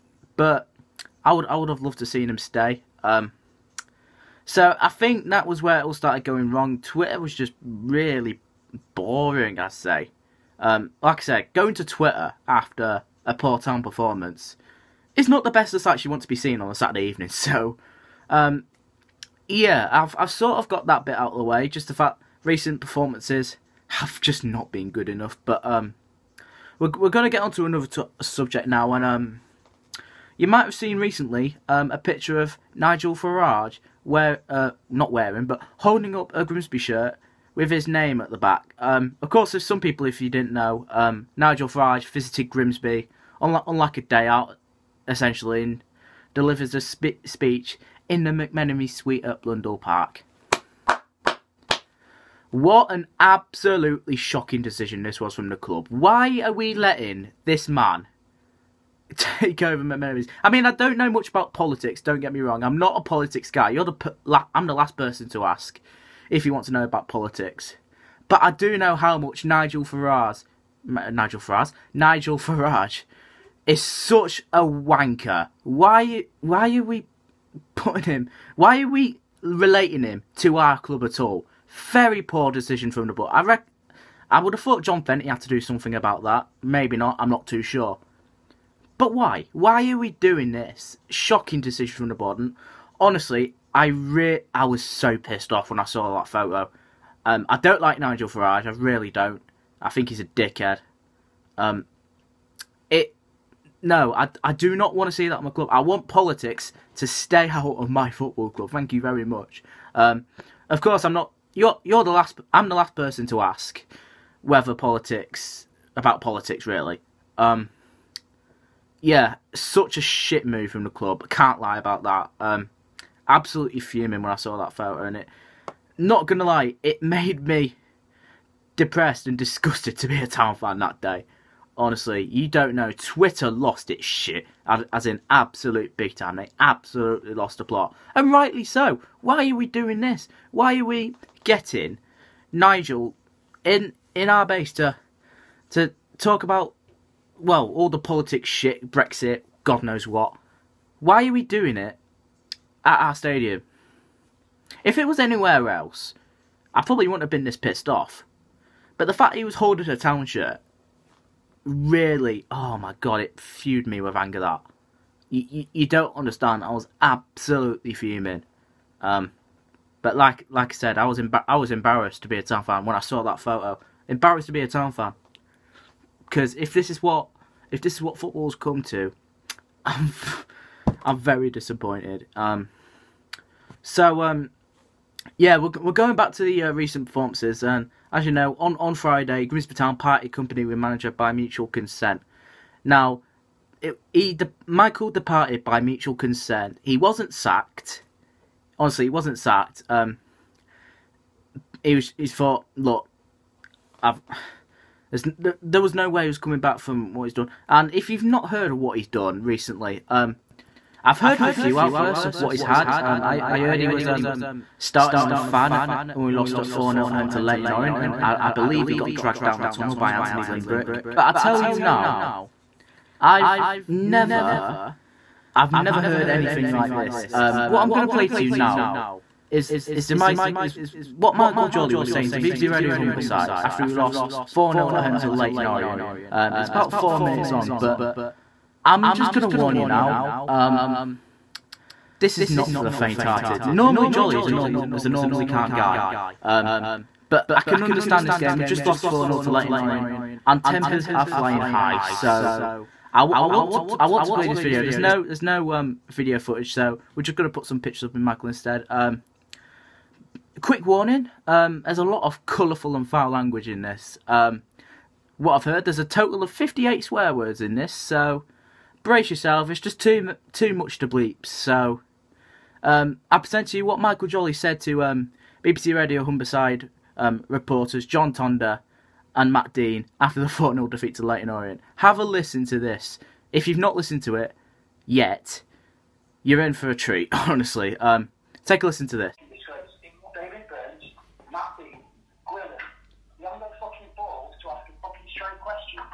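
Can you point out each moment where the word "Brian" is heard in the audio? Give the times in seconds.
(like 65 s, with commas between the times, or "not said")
not said.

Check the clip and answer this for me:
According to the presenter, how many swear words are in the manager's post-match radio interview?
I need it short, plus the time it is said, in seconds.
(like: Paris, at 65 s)
58, at 266 s.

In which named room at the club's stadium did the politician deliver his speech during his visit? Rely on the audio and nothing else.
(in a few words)
McMenemy Suite.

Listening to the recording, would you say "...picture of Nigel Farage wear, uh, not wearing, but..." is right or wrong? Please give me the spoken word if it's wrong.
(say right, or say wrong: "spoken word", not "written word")
right.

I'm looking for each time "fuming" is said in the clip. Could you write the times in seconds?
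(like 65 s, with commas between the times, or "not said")
123 s, 167 s.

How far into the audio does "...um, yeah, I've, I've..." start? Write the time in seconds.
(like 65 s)
18 s.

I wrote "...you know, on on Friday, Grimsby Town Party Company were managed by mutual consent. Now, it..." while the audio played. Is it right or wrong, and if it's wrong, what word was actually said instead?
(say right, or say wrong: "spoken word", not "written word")
right.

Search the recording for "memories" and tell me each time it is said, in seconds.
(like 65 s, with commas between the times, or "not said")
59 s.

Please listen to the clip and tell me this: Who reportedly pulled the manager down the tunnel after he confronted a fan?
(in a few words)
Anthony Limbrick.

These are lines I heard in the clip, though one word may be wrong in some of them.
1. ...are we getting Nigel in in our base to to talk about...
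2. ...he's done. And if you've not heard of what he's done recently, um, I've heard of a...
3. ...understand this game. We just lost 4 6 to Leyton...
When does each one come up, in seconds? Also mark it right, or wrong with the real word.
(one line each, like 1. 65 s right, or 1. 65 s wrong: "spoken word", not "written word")
1. 140 s right
2. 207 s right
3. 247 s wrong: "0", not "6".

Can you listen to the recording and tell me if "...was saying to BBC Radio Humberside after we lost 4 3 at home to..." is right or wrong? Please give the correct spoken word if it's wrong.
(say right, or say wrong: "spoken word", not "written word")
wrong: "0", not "3".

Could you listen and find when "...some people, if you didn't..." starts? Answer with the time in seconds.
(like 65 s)
39 s.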